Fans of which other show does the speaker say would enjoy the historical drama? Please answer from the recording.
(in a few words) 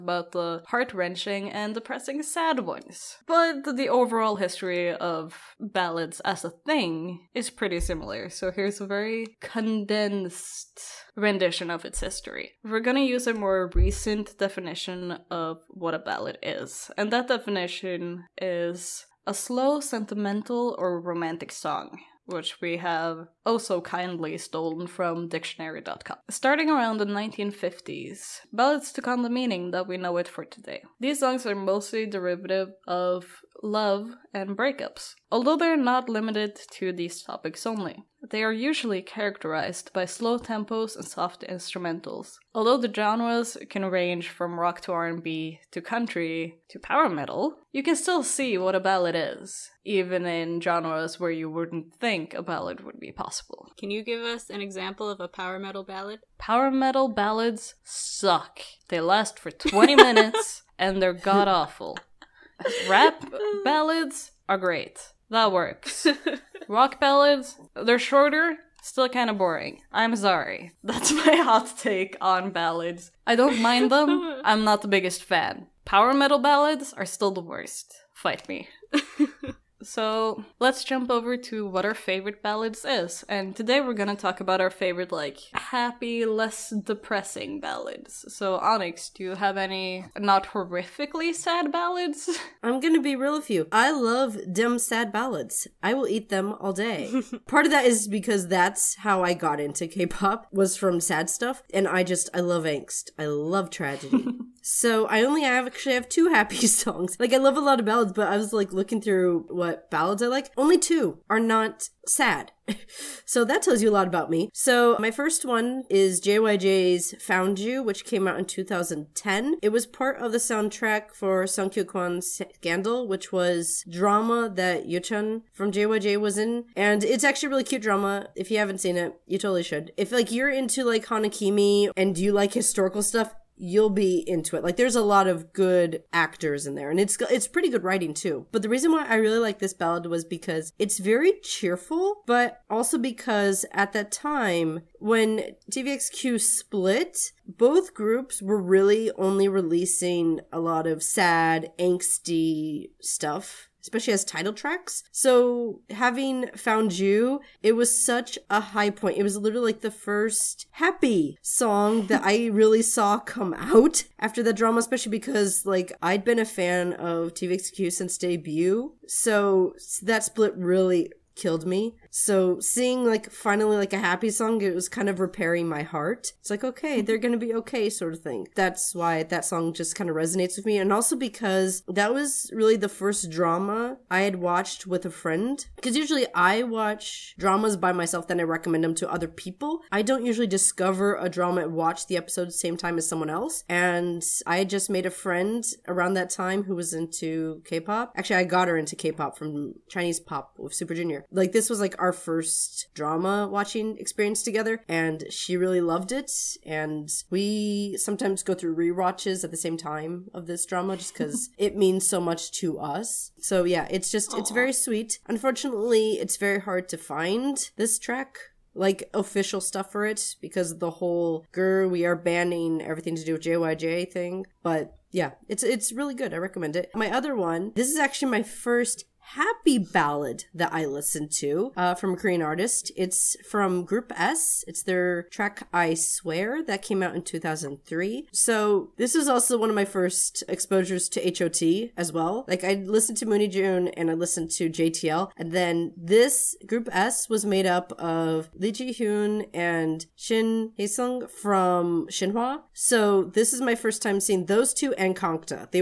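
Hanakimi.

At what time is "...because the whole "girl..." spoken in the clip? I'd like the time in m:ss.
3:40.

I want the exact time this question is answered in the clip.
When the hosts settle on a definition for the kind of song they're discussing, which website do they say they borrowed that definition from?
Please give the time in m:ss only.
0:25.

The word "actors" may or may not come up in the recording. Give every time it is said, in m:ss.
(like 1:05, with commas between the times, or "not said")
2:16.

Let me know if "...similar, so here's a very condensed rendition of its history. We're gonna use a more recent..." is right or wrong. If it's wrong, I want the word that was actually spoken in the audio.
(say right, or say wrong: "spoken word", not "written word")
right.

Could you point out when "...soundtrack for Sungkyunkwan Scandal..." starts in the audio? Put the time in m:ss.
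2:00.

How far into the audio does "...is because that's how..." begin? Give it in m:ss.
1:37.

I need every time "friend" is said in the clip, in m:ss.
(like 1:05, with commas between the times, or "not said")
3:05, 3:15.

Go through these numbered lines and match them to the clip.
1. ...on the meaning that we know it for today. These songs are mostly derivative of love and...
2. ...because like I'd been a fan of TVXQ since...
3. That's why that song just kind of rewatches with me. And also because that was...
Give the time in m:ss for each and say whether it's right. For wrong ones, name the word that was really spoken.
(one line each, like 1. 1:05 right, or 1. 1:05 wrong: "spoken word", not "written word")
1. 0:29 right
2. 2:45 right
3. 2:58 wrong: "resonates", not "rewatches".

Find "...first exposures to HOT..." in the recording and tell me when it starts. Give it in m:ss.
3:59.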